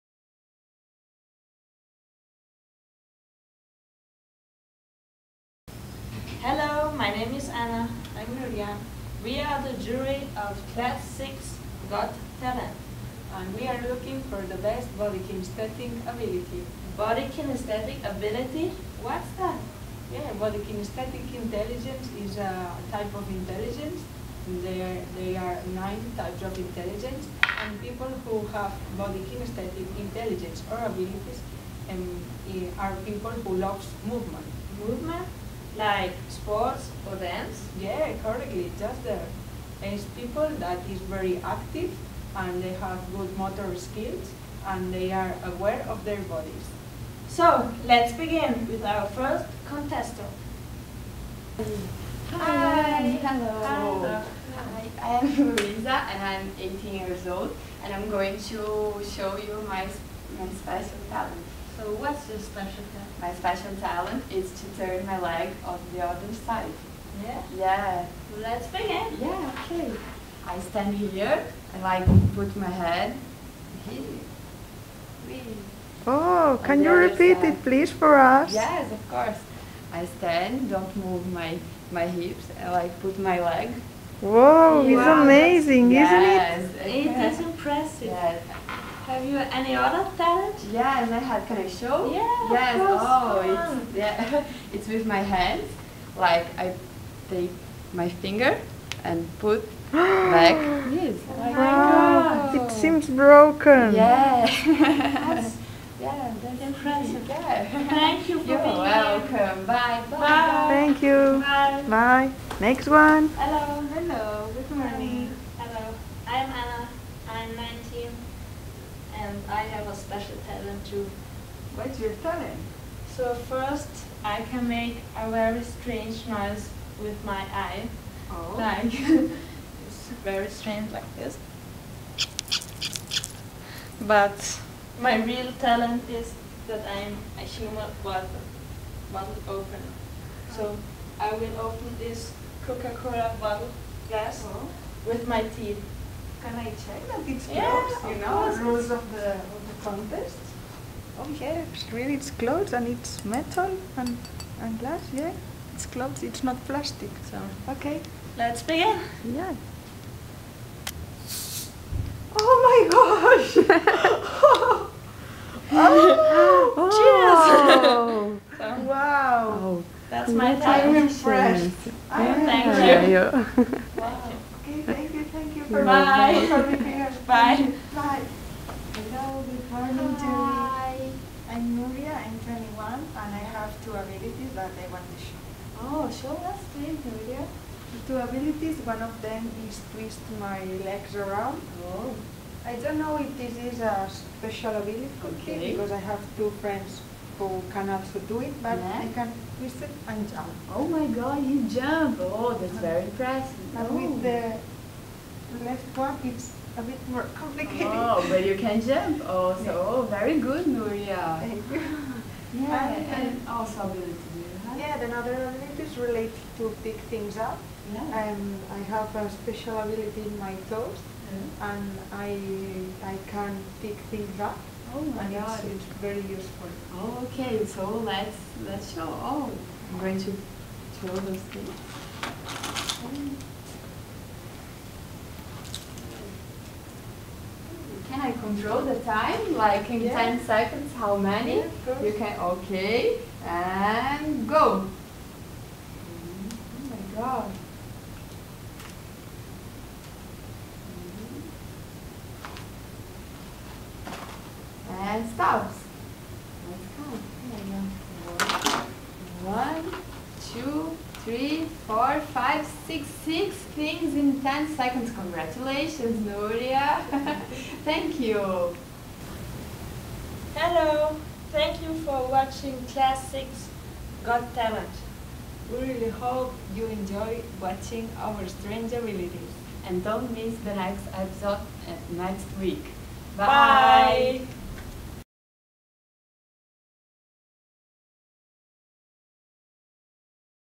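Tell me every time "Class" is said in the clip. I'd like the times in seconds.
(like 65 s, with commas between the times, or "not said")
10 s, 272 s.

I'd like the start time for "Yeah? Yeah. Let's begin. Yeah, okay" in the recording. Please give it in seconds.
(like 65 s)
67 s.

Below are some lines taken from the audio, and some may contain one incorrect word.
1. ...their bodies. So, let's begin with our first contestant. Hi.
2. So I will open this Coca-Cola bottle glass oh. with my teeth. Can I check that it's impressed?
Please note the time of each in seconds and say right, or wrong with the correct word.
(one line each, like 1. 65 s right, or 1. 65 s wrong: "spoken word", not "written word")
1. 46 s right
2. 140 s wrong: "closed", not "impressed".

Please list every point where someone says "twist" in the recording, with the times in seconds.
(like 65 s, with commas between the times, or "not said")
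189 s, 199 s.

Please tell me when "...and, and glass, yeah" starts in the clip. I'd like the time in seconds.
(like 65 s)
153 s.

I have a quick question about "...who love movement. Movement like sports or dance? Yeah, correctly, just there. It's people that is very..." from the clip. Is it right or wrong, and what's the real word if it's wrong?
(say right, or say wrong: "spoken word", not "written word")
right.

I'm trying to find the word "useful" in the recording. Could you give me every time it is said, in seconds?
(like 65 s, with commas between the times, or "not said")
226 s.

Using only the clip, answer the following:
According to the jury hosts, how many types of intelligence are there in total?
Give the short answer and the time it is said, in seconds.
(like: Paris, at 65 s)
9, at 25 s.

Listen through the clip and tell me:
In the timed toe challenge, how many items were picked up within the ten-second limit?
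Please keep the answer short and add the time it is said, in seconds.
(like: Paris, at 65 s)
6, at 263 s.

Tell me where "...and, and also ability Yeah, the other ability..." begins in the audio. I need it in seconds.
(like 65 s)
212 s.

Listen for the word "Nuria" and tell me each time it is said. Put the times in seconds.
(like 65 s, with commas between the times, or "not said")
8 s, 181 s, 187 s, 210 s, 266 s.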